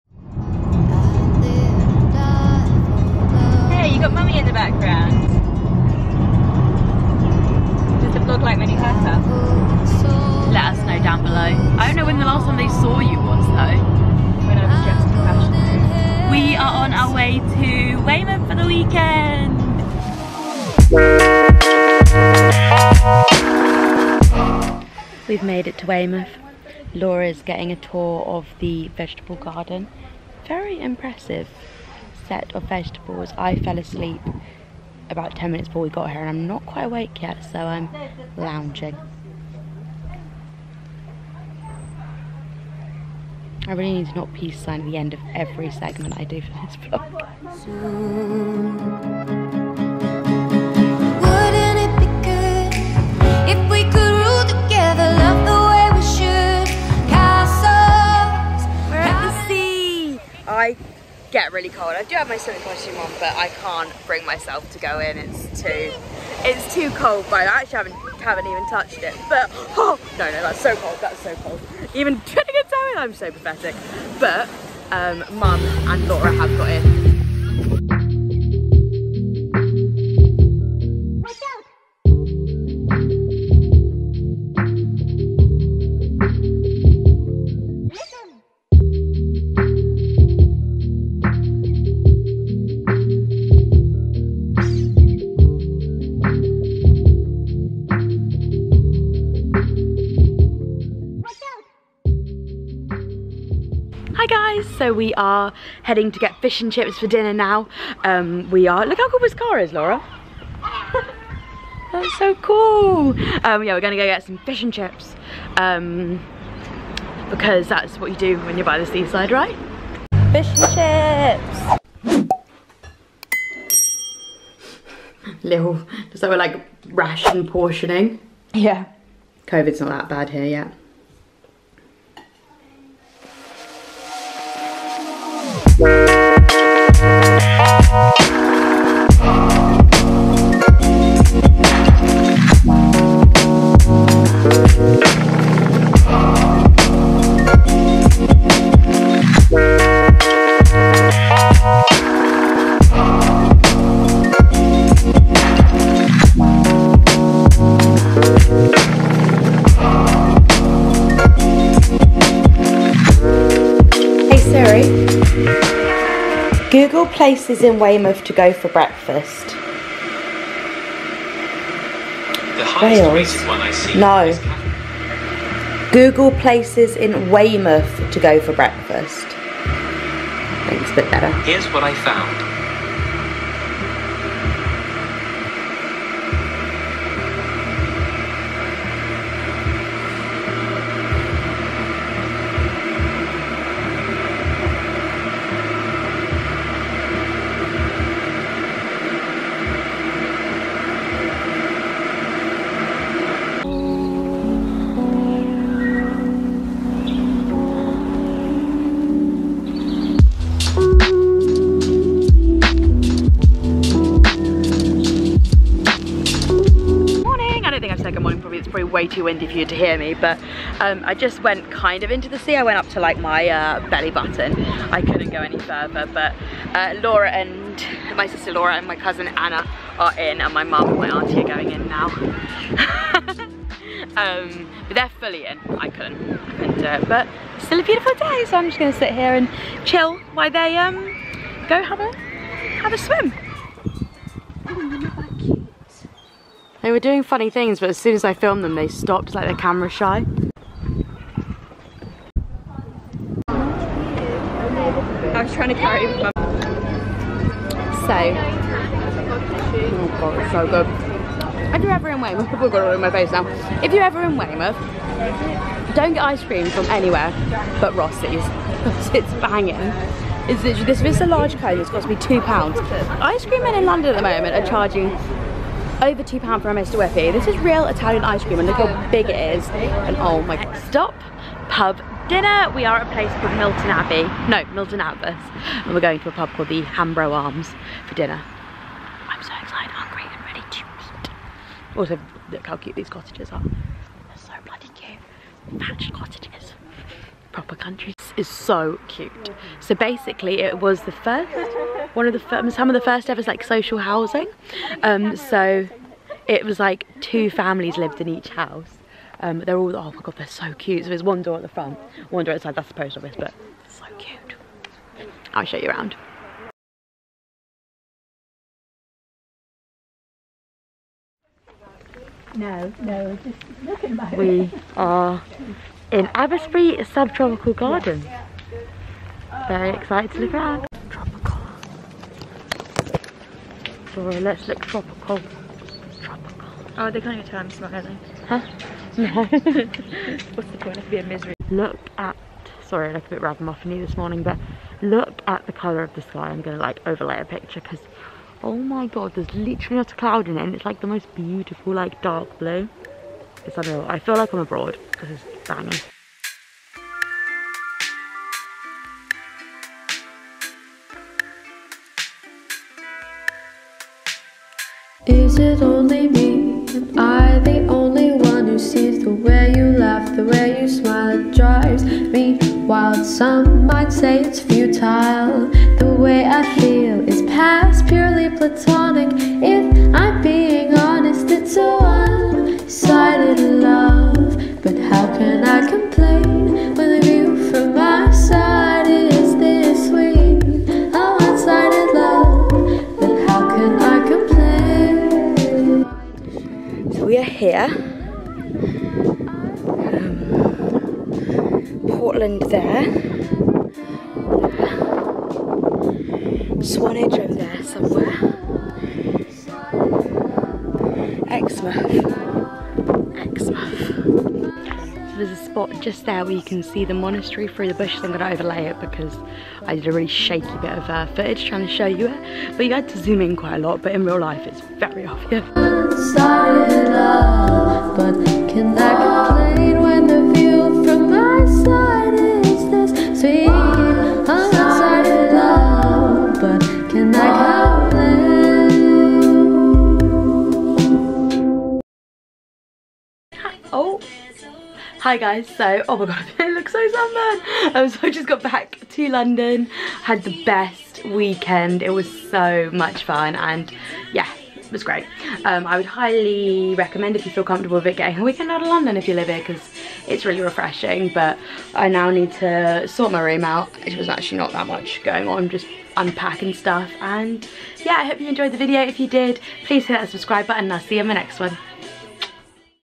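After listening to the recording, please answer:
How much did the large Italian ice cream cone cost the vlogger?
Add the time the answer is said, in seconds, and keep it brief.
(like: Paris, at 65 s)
£2, at 271 s.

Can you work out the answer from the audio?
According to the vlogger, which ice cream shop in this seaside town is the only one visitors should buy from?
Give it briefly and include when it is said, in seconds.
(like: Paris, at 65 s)
Rossi's, at 267 s.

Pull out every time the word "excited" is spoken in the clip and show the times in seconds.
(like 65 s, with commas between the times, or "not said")
289 s, 329 s.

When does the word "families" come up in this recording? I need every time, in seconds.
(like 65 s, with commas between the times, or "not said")
307 s.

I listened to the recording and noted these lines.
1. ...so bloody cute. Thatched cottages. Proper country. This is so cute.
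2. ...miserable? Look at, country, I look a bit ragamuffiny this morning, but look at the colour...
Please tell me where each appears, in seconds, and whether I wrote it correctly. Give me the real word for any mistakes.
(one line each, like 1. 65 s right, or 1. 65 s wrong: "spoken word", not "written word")
1. 294 s right
2. 341 s wrong: "sorry", not "country".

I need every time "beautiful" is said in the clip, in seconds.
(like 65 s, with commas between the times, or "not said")
237 s, 351 s.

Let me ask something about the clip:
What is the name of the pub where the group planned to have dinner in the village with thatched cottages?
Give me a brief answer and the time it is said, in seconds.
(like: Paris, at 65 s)
Hambro Arms, at 286 s.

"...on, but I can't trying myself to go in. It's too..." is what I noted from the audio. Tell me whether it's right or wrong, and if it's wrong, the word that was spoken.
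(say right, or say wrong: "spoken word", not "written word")
wrong: "bring", not "trying".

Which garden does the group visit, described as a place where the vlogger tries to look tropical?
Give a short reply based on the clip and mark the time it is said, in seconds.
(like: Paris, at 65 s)
Abbotsbury Subtropical Garden, at 326 s.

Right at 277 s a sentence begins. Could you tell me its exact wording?
This is real Italian ice cream and look how big it is.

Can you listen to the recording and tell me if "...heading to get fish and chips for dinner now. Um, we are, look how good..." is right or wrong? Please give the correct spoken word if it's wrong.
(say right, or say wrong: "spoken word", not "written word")
right.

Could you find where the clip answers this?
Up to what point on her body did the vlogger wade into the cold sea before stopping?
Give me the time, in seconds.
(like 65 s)
223 s.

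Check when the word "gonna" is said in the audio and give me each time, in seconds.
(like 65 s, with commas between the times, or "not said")
113 s, 238 s.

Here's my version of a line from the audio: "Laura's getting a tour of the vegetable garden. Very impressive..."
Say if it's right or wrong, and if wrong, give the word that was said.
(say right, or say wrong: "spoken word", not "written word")
right.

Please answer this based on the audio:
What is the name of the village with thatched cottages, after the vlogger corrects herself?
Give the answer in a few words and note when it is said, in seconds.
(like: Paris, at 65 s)
Milton Abbas, at 284 s.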